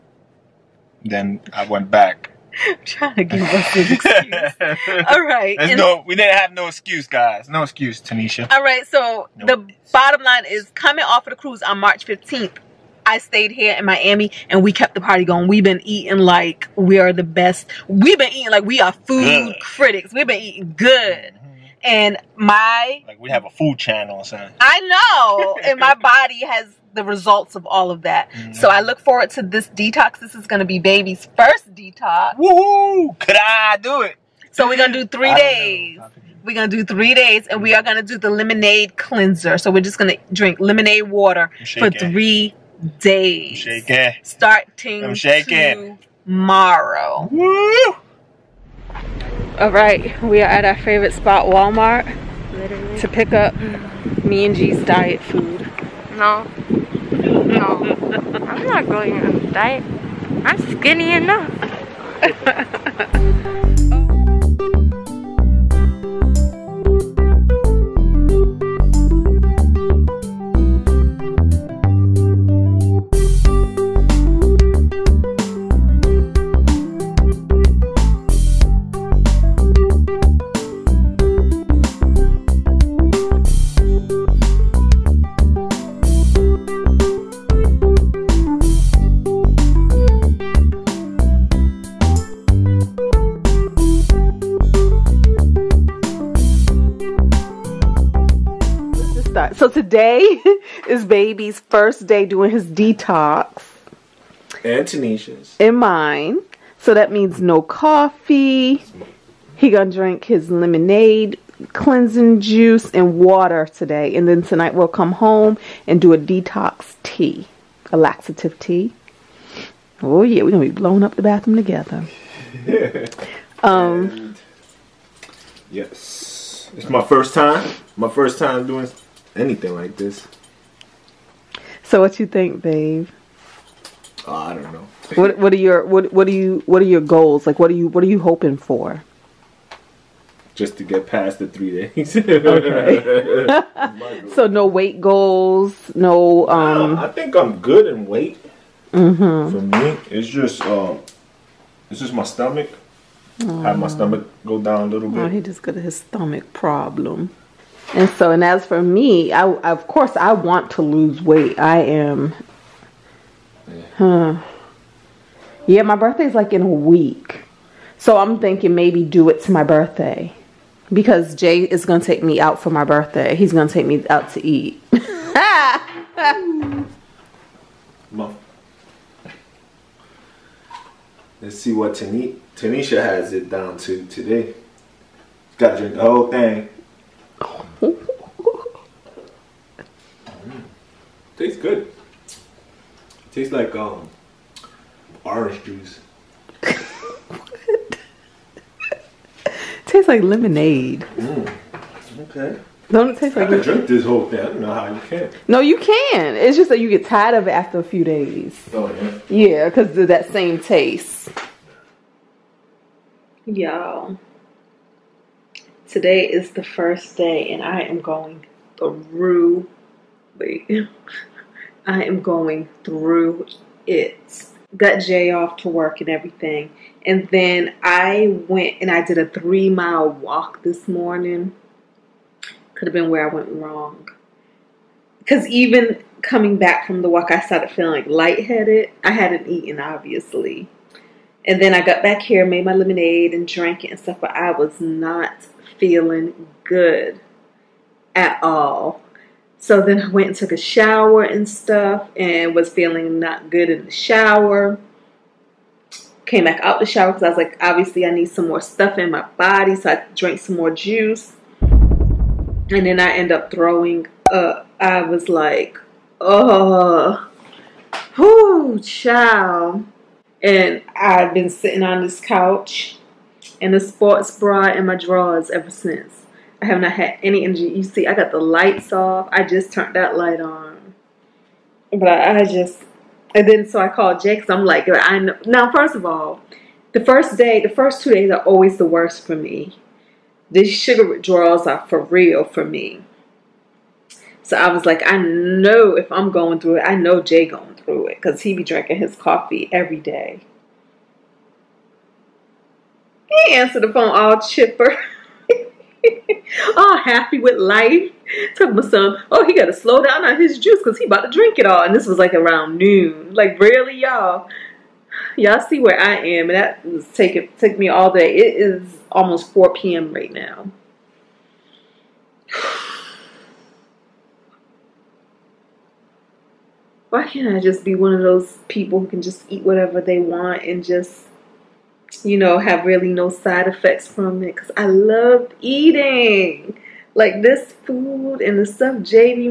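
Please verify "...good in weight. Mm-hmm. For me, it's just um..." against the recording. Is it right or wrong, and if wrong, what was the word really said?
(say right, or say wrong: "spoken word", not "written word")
right.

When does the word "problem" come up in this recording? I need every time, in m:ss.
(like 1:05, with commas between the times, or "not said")
2:36.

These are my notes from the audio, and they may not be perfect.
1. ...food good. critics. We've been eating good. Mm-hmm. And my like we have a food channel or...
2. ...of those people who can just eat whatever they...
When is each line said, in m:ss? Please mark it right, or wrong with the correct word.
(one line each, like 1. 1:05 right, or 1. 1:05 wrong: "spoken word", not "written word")
1. 0:18 right
2. 5:28 right.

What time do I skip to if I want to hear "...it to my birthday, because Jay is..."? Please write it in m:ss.
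2:49.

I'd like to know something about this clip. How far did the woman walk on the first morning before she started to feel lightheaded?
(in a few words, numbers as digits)
3 miles.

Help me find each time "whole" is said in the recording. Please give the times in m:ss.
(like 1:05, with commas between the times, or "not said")
3:06, 3:24.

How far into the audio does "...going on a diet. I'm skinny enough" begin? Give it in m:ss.
0:58.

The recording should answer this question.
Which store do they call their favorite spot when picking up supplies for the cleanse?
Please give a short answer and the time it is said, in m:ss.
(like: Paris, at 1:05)
Walmart, at 0:51.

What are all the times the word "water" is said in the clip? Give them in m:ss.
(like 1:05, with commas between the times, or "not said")
0:41, 1:53.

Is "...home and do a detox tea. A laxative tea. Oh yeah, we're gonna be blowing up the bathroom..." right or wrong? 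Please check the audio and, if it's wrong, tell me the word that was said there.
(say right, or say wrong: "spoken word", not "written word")
right.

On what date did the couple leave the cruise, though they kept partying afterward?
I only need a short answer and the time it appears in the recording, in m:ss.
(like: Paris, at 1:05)
March 15, at 0:11.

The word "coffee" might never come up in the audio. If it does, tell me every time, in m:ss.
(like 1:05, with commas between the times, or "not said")
1:47, 4:59.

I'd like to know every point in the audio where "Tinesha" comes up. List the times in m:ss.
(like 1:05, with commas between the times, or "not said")
0:08, 1:44, 3:01.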